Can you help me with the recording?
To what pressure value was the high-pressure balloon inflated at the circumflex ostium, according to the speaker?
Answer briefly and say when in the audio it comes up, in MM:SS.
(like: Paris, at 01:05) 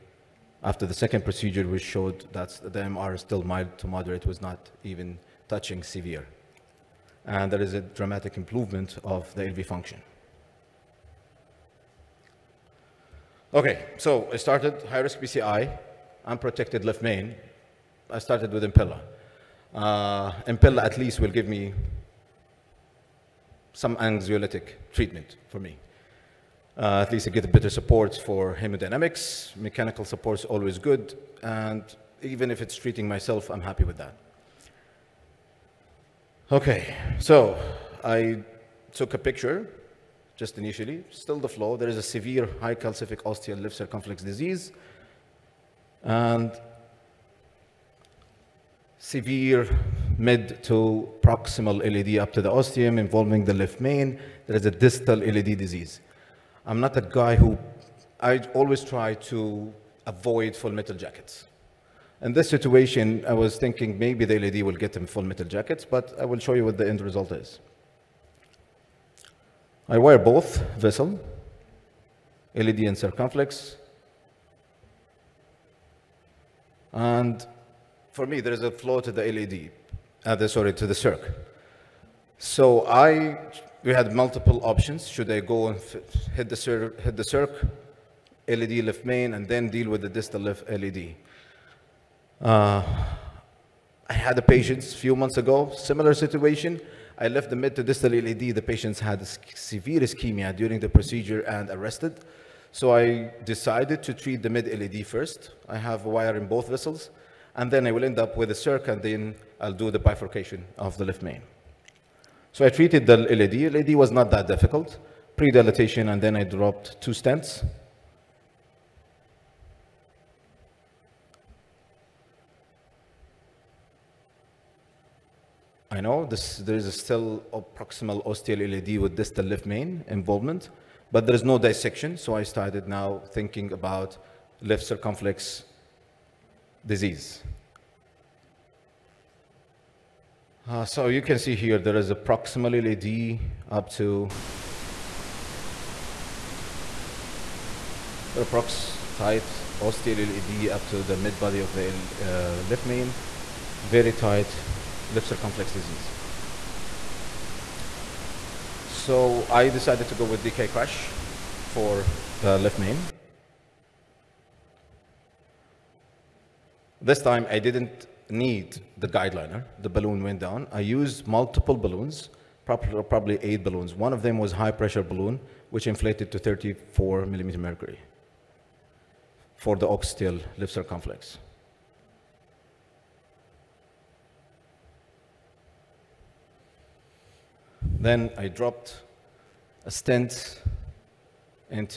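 34, at 02:56.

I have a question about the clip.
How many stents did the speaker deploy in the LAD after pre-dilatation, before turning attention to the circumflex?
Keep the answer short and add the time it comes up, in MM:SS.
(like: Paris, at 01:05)
2, at 01:57.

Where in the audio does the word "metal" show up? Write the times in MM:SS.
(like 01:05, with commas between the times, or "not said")
01:00, 01:05.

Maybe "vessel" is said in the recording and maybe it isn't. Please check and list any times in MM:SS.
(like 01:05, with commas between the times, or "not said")
01:10, 01:46.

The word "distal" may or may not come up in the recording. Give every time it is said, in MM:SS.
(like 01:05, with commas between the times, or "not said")
00:54, 01:30, 01:37, 02:09.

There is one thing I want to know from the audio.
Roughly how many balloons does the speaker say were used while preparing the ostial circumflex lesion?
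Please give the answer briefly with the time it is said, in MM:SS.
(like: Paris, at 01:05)
8, at 02:53.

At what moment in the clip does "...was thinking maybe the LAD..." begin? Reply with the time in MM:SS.
01:03.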